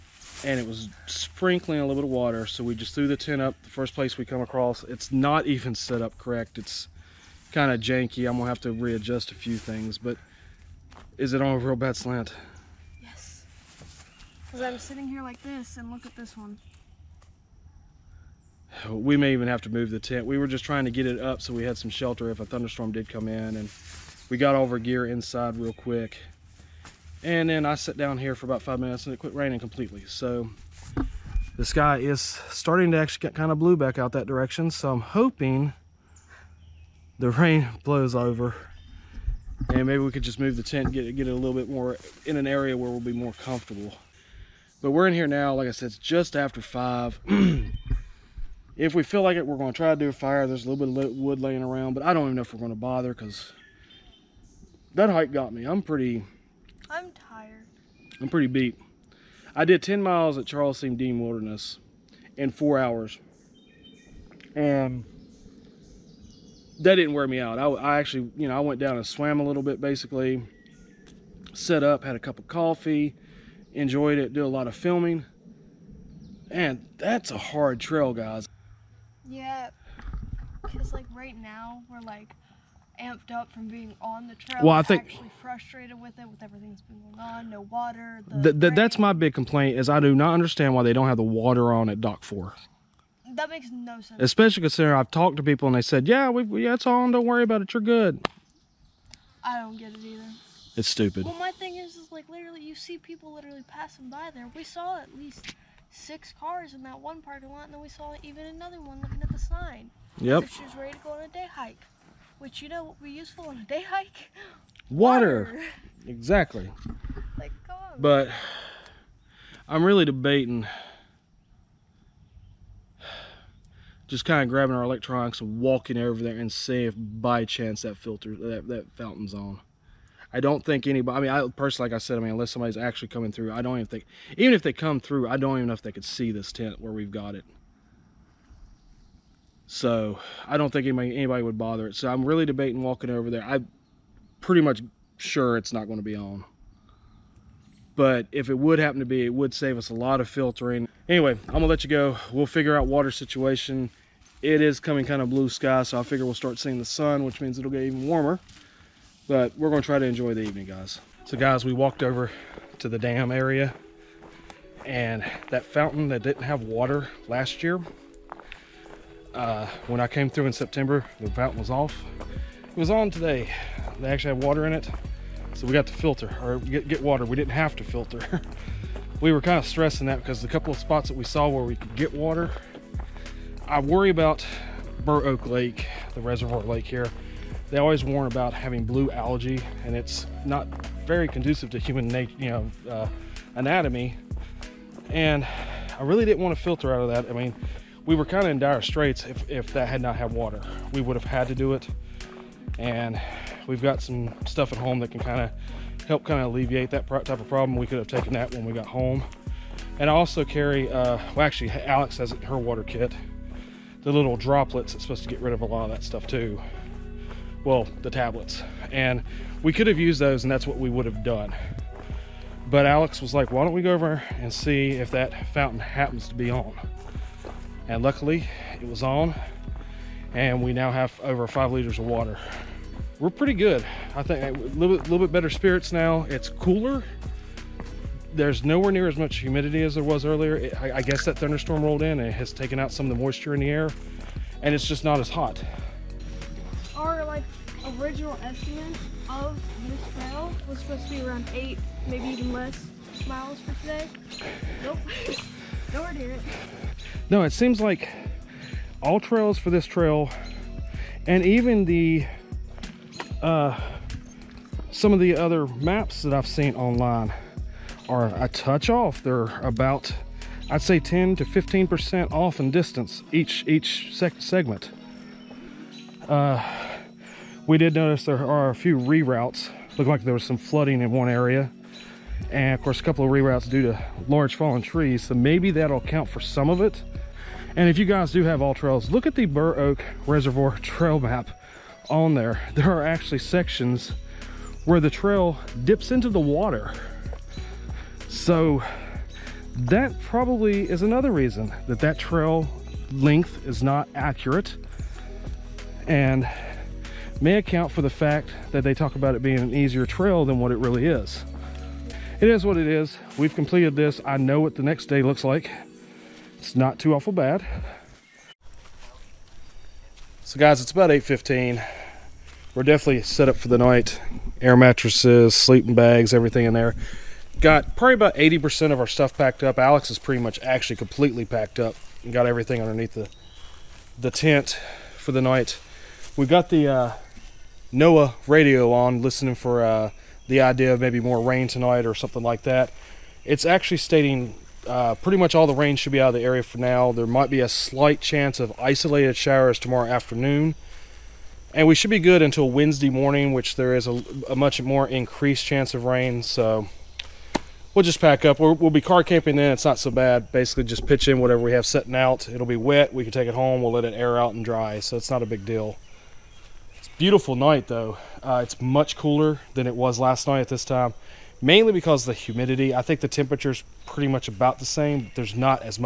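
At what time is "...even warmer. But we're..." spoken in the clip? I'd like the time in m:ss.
2:37.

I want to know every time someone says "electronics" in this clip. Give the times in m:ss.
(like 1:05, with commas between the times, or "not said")
2:04.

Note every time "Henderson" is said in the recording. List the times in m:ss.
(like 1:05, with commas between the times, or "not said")
not said.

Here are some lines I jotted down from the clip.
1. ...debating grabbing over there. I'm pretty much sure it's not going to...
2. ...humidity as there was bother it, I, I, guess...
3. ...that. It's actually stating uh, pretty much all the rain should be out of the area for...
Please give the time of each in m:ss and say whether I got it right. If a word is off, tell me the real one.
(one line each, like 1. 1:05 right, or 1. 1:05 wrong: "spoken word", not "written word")
1. 2:22 wrong: "walking", not "grabbing"
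2. 3:59 wrong: "earlier", not "bother"
3. 5:42 right.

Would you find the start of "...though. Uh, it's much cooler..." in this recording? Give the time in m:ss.
6:07.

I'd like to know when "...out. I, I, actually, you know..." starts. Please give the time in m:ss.
1:07.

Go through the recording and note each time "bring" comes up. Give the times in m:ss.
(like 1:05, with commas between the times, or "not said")
not said.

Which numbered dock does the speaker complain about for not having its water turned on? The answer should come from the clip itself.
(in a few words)
Dock Four.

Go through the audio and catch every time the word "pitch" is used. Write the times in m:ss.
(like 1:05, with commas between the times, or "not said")
6:01.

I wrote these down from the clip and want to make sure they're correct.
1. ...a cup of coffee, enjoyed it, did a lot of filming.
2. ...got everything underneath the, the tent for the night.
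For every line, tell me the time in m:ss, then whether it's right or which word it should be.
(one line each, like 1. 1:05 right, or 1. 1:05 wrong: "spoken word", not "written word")
1. 1:12 right
2. 5:32 right.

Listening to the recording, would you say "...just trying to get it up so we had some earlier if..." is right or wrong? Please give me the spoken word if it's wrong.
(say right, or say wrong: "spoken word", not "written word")
wrong: "shelter", not "earlier".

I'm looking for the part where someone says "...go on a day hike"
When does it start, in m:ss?
1:50.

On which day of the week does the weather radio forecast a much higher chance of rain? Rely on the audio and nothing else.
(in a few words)
Wednesday.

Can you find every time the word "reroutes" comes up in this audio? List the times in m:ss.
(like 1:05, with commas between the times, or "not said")
4:38, 4:43.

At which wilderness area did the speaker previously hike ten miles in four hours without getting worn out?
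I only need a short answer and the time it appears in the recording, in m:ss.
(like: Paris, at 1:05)
Charles C. Deam Wilderness, at 1:00.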